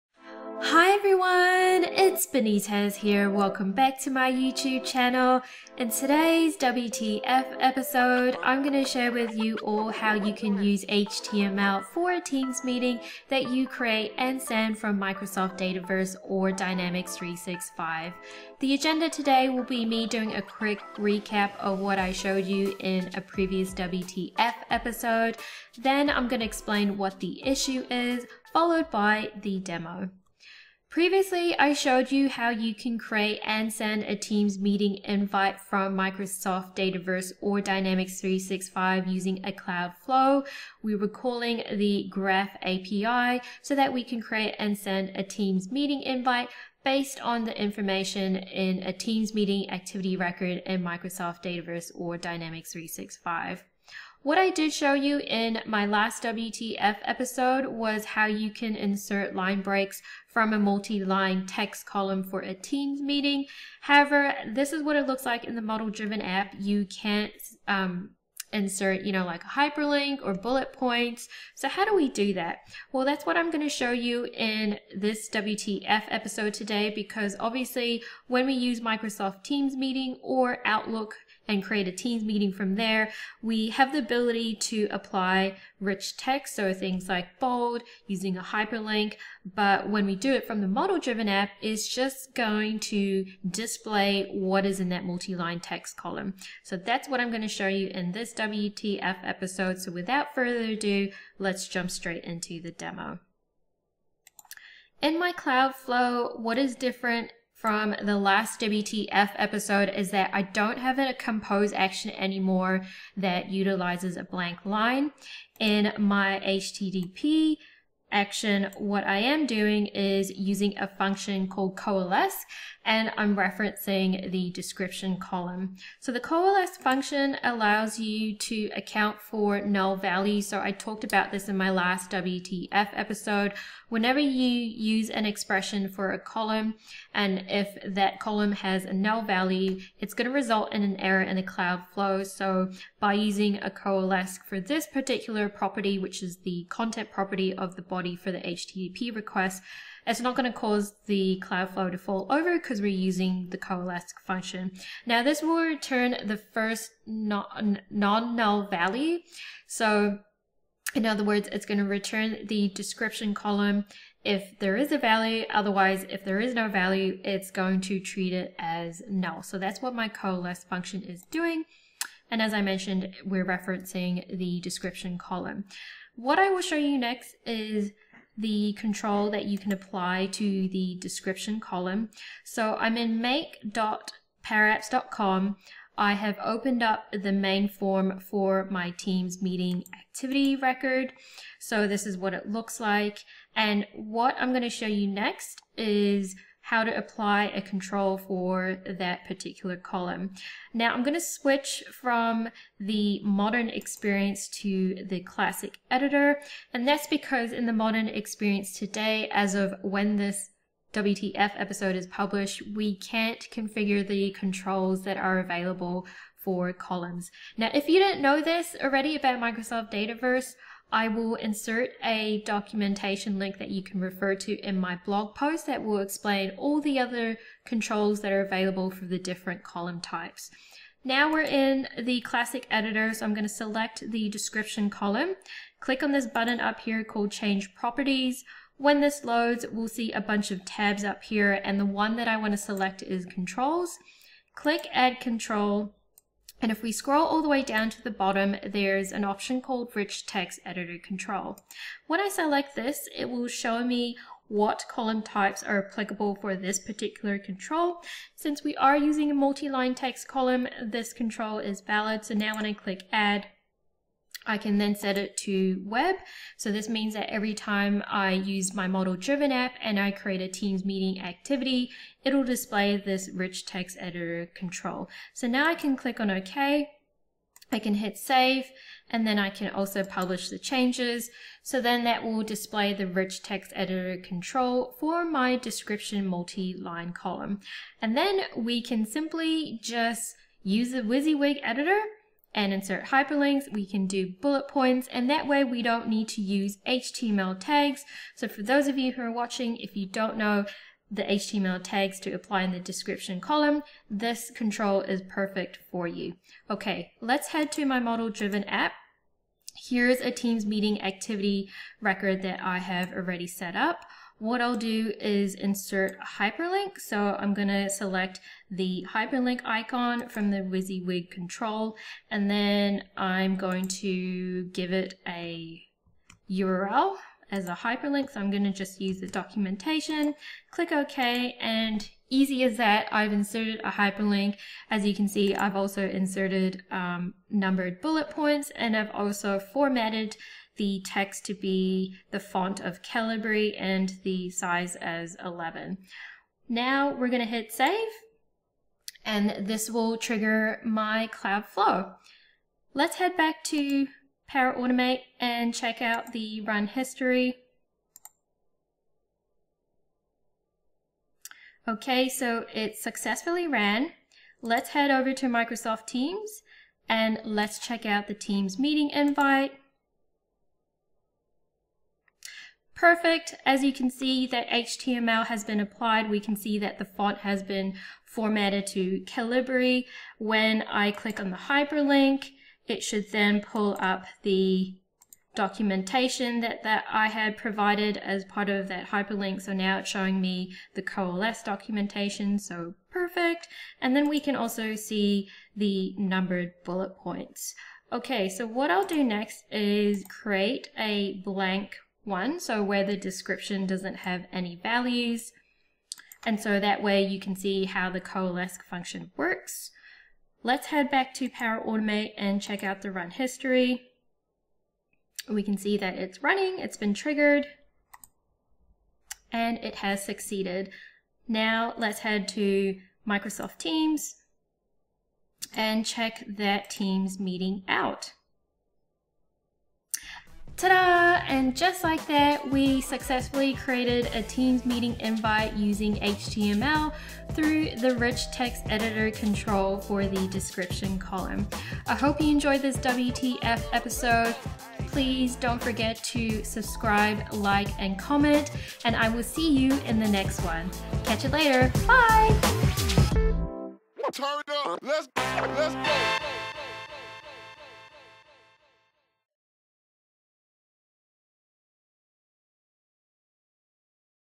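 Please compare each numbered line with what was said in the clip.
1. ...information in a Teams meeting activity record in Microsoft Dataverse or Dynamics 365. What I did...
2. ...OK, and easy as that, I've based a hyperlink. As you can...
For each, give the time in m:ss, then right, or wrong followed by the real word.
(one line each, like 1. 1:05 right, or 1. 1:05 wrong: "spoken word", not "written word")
1. 0:47 right
2. 5:30 wrong: "inserted", not "based".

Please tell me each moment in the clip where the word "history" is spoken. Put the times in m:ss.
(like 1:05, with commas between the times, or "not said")
5:56, 6:53.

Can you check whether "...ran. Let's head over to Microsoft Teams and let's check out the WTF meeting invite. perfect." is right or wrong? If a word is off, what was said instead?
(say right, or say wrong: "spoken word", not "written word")
wrong: "Teams", not "WTF".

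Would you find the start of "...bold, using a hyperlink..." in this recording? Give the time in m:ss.
1:27.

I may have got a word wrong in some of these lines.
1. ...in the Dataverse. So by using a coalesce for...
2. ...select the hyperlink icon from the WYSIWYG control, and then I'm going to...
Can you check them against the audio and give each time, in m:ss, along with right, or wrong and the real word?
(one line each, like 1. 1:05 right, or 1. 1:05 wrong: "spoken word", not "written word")
1. 2:21 wrong: "Cloudflow", not "Dataverse"
2. 5:17 right.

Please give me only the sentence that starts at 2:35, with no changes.
Now this will return the first non-null value.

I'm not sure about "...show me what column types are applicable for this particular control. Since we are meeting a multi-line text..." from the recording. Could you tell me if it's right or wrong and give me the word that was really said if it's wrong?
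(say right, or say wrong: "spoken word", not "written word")
wrong: "using", not "meeting".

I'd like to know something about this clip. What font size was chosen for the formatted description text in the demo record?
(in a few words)
11.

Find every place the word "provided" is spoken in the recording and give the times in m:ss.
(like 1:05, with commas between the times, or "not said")
6:27.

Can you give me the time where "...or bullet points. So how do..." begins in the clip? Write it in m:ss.
1:10.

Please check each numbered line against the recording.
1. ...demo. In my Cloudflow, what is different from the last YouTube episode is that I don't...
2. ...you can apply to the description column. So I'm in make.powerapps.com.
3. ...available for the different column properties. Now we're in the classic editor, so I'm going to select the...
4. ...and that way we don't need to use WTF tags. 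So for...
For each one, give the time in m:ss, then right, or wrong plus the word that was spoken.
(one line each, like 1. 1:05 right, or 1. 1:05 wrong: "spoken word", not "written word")
1. 1:42 wrong: "WTF", not "YouTube"
2. 2:59 right
3. 3:48 wrong: "types", not "properties"
4. 4:55 wrong: "HTML", not "WTF".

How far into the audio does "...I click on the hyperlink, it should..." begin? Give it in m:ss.
6:20.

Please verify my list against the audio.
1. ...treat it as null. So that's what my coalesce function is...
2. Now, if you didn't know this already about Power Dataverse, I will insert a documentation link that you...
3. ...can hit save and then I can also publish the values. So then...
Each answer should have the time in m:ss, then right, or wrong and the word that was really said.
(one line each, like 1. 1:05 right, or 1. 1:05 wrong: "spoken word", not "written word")
1. 2:47 right
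2. 3:37 wrong: "Microsoft", not "Power"
3. 4:37 wrong: "changes", not "values".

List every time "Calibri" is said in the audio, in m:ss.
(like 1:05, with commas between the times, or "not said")
5:43, 6:19.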